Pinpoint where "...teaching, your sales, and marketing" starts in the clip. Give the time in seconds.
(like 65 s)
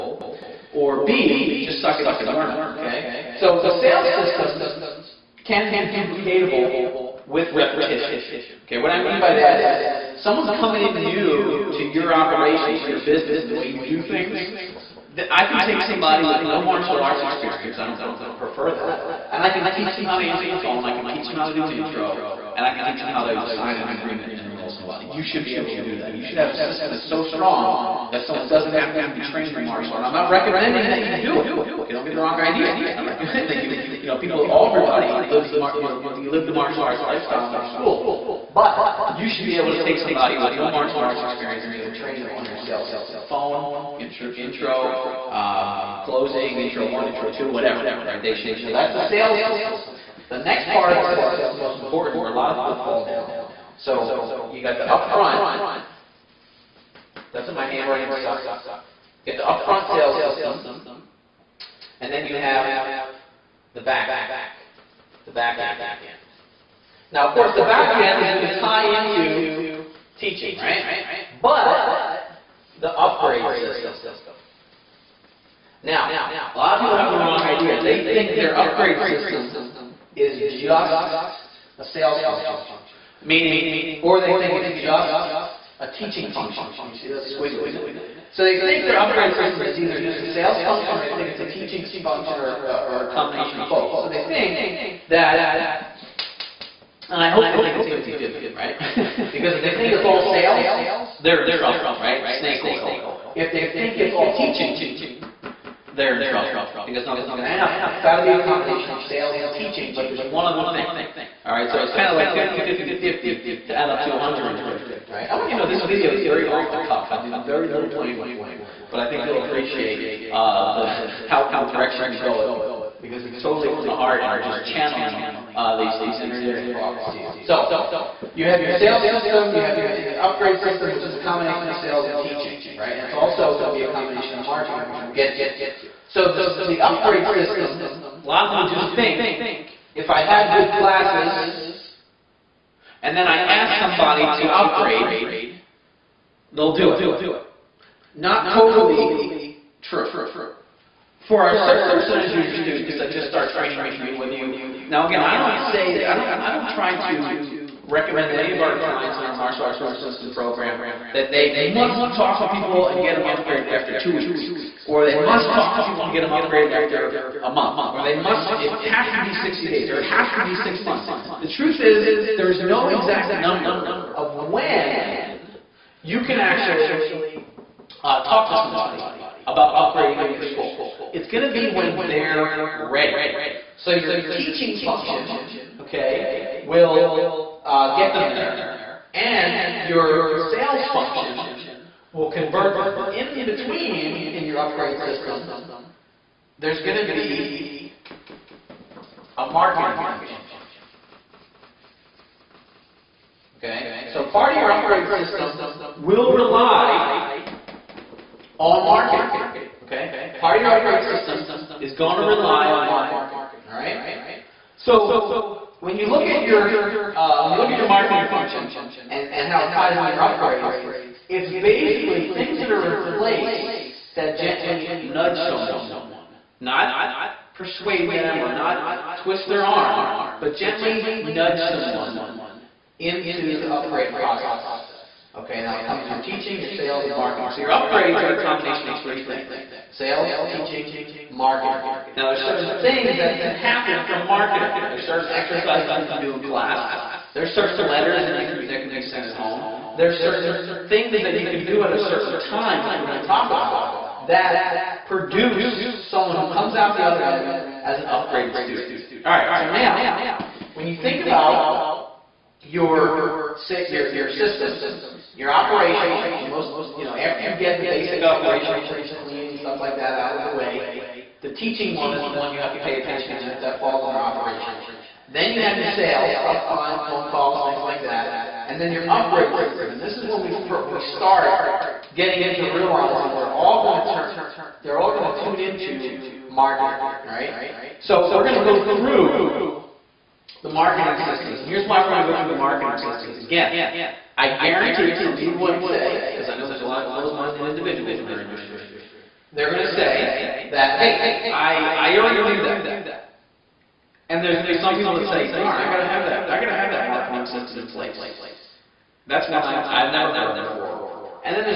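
236 s.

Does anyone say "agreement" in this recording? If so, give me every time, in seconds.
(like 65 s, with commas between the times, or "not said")
23 s.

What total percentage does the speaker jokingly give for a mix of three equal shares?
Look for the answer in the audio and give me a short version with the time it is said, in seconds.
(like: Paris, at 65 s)
150, at 114 s.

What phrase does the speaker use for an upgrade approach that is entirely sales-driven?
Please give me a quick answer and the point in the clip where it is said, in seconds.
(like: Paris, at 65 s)
Snake oil, at 102 s.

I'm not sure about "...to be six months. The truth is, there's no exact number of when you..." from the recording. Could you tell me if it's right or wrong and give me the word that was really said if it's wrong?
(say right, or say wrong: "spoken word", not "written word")
right.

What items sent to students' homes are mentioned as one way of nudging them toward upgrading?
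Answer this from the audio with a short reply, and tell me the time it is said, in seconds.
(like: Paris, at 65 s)
Letters, at 247 s.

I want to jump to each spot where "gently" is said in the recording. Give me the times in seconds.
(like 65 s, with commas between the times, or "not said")
224 s, 230 s.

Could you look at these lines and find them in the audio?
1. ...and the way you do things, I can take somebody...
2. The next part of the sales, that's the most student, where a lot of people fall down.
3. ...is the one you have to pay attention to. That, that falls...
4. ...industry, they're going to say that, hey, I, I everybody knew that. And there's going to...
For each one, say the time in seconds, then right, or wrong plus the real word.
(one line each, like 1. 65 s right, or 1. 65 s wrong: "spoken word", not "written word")
1. 13 s right
2. 50 s wrong: "important", not "student"
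3. 272 s right
4. 298 s wrong: "already", not "everybody".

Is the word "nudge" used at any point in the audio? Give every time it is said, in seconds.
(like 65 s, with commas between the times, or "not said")
225 s, 231 s.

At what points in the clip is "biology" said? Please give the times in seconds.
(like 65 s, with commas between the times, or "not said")
not said.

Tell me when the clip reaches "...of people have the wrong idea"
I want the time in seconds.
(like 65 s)
76 s.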